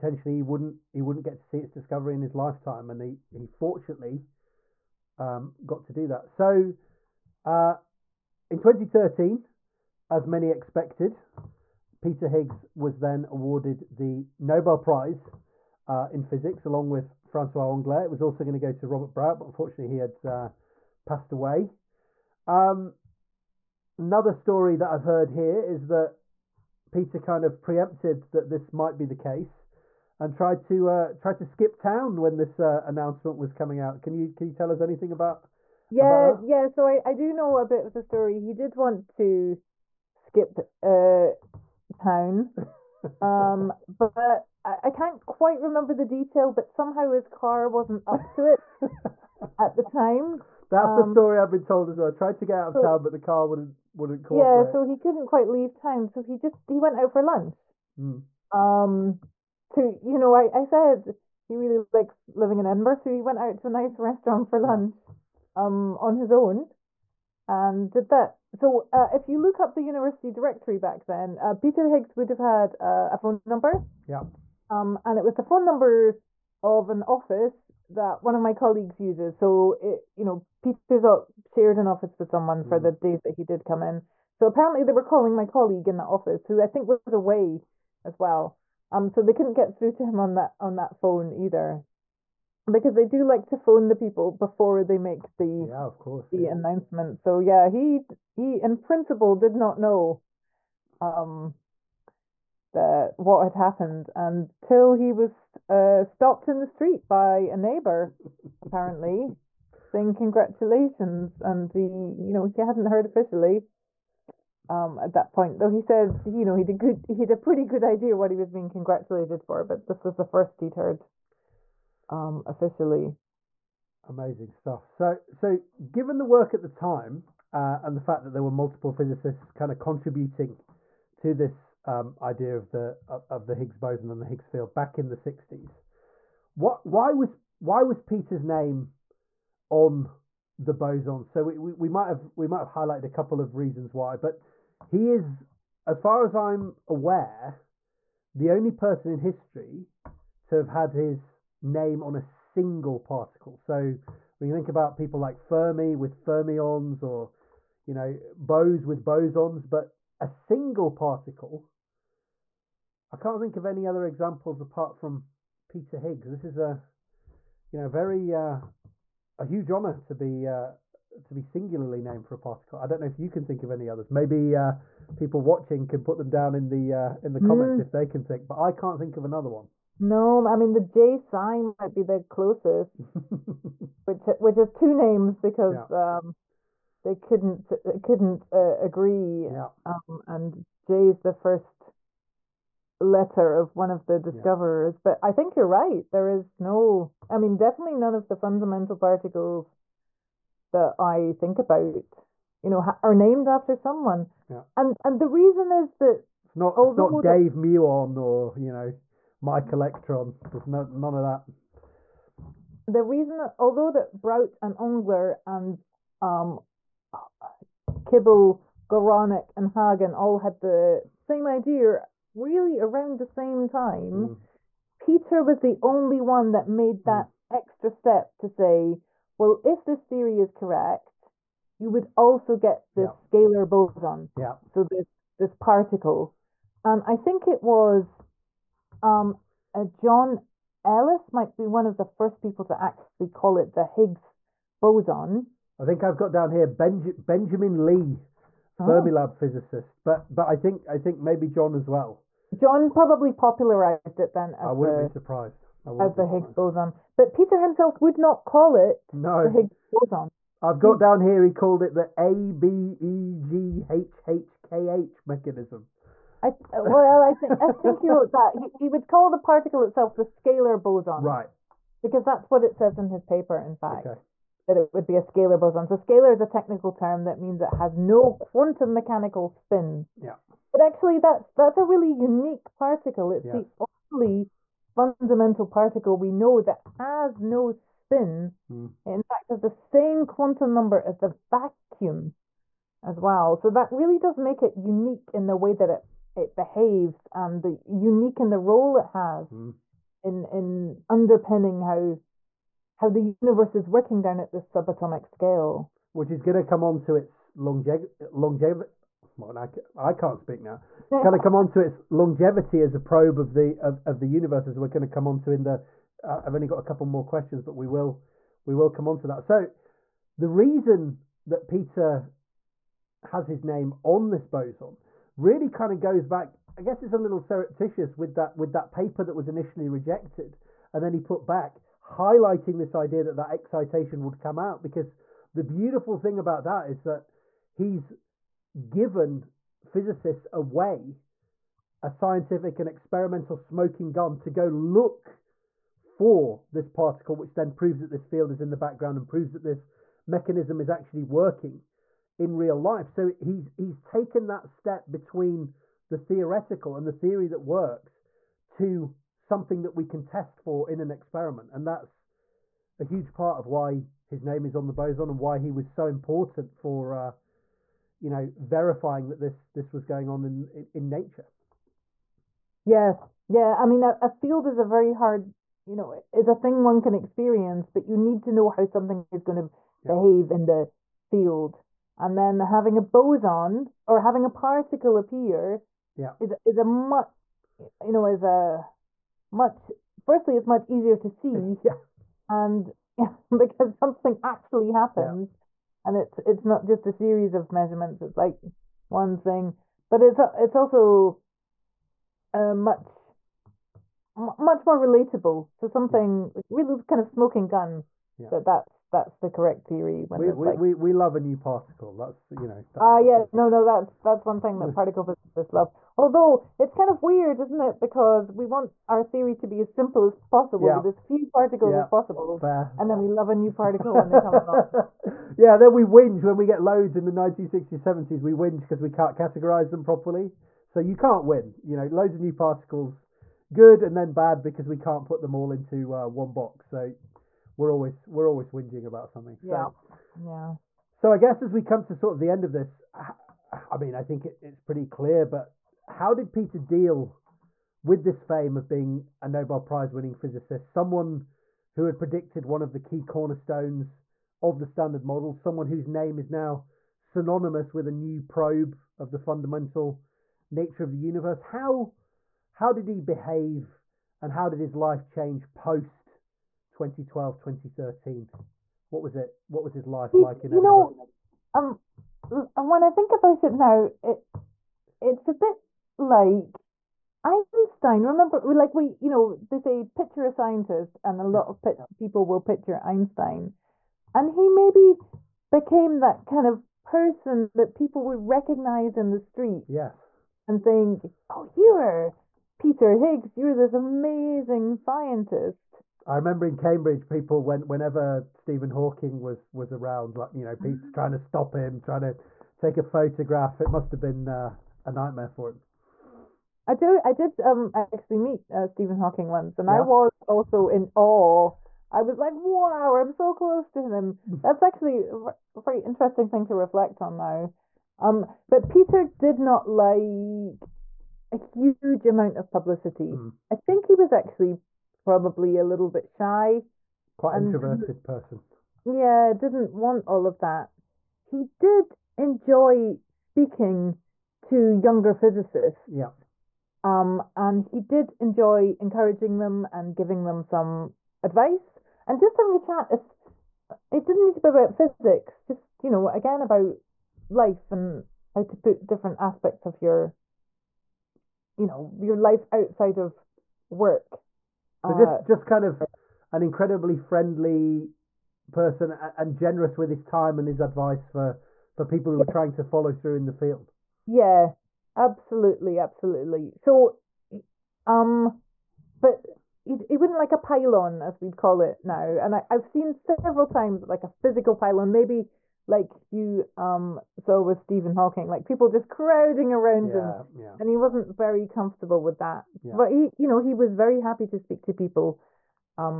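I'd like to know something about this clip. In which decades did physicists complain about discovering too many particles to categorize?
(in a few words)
1960s, 70s.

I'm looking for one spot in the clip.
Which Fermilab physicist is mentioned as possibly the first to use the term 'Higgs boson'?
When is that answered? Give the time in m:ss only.
4:07.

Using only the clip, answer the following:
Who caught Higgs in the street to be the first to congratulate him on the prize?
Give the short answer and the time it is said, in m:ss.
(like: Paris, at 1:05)
A neighbor, at 1:47.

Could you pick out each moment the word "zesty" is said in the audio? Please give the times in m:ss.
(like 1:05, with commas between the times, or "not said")
not said.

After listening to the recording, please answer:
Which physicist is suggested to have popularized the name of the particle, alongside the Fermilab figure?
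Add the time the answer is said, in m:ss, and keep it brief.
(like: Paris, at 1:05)
John Ellis, at 3:59.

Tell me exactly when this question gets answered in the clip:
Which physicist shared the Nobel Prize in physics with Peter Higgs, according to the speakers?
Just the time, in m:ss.
0:17.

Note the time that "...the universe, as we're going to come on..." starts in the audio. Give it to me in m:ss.
5:14.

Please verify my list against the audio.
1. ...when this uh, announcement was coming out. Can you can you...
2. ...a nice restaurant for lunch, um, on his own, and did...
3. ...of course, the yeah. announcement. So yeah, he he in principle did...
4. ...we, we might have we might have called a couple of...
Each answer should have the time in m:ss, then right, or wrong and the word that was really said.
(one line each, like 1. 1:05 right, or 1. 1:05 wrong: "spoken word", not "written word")
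1. 0:32 right
2. 1:03 right
3. 1:35 right
4. 2:21 wrong: "highlighted", not "called".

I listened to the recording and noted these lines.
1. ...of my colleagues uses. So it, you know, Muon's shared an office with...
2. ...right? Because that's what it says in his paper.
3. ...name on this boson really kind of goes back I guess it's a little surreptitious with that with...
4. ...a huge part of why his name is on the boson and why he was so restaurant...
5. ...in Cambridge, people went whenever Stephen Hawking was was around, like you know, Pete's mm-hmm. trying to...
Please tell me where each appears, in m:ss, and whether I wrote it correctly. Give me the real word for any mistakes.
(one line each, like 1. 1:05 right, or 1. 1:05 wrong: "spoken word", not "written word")
1. 1:18 wrong: "Peter", not "Muon"
2. 4:31 right
3. 5:23 right
4. 6:02 wrong: "important", not "restaurant"
5. 8:16 right.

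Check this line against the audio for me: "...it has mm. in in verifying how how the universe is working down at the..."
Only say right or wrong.
wrong.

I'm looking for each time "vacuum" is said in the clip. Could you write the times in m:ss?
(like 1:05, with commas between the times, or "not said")
4:51.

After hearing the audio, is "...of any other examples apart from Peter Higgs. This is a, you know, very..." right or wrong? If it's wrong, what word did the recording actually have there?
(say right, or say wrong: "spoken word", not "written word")
right.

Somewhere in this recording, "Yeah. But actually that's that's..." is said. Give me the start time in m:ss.
4:40.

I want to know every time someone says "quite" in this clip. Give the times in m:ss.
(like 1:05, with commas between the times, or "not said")
0:45, 0:55, 8:47.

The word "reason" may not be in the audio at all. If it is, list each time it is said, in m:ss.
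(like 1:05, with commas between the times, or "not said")
2:23, 3:25, 3:33, 5:20.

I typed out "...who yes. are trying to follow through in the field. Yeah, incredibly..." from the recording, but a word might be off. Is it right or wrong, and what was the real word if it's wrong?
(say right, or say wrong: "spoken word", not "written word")
wrong: "absolutely", not "incredibly".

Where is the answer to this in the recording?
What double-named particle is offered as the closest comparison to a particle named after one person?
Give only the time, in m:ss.
3:00.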